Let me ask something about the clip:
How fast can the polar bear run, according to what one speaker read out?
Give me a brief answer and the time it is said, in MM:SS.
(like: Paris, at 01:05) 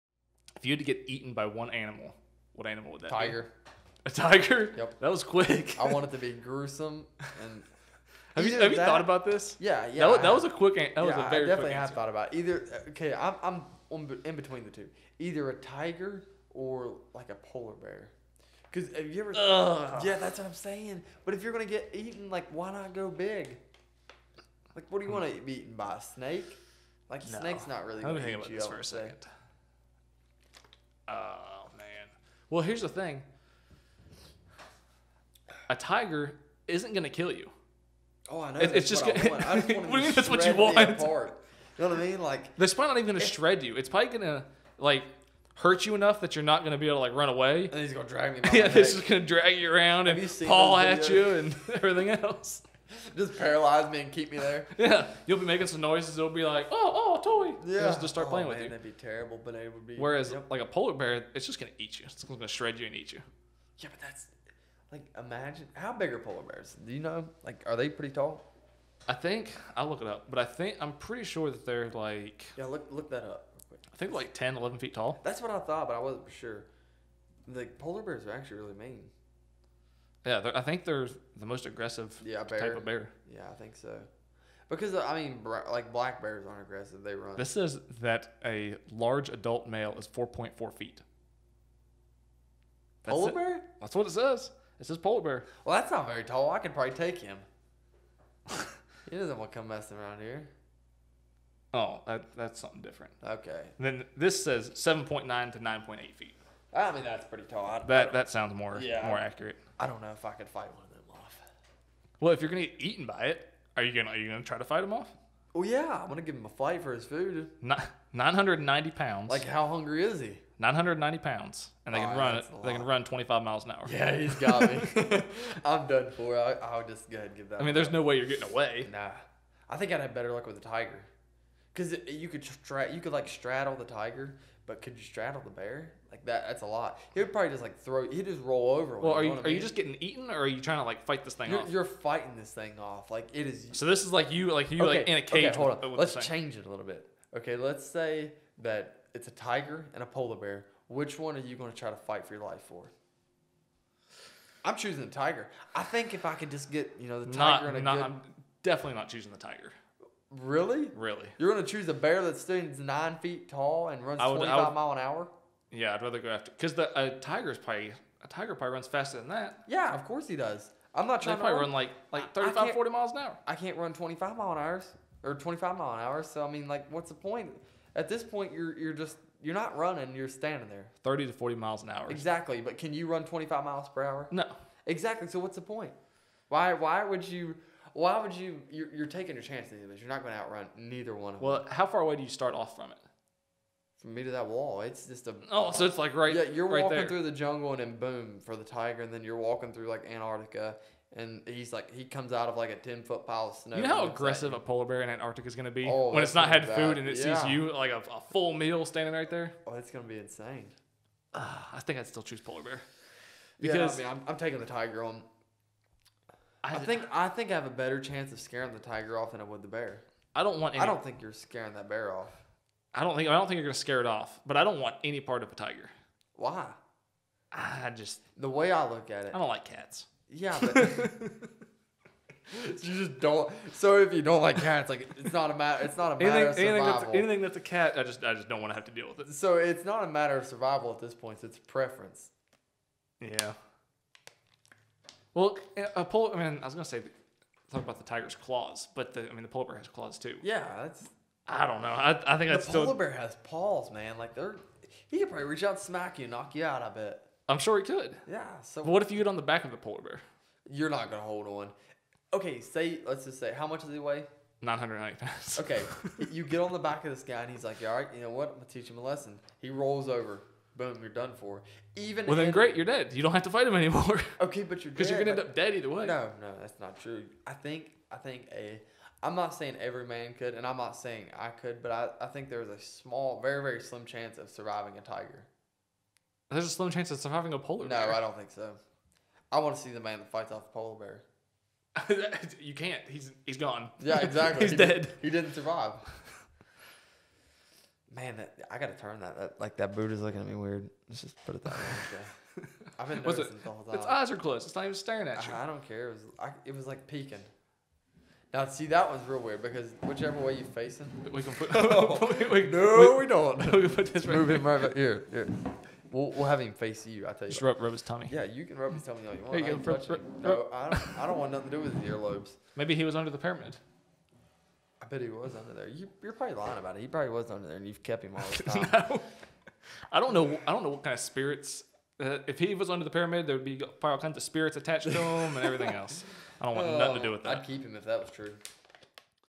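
25 miles an hour, at 02:03.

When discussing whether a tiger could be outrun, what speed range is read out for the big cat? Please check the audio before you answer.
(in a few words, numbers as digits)
30 to 40 miles an hour.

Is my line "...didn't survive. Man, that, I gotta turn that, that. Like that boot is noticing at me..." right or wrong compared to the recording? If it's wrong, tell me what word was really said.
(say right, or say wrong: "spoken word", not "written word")
wrong: "looking", not "noticing".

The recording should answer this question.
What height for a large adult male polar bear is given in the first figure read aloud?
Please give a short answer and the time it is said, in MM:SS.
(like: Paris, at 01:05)
4.4 feet, at 01:30.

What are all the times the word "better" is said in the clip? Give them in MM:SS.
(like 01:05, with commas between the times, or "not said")
02:10, 03:37.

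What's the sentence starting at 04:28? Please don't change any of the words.
I'm gonna teach him a lesson.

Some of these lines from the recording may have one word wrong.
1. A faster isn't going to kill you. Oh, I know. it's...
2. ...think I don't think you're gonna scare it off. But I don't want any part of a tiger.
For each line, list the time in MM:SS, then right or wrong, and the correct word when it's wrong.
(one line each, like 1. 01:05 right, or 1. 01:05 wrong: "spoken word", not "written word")
1. 00:35 wrong: "tiger", not "faster"
2. 03:43 right.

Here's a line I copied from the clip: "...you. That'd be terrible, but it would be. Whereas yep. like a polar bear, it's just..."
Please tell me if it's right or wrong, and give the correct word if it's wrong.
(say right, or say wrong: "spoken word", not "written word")
right.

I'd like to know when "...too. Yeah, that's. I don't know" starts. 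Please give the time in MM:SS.
04:10.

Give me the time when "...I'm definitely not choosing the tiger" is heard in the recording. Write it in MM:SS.
02:38.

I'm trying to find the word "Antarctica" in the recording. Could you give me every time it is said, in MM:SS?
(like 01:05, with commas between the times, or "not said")
03:20, 03:25.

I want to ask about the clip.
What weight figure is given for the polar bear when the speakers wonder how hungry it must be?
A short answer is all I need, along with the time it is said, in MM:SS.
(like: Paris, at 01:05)
990 pounds, at 01:57.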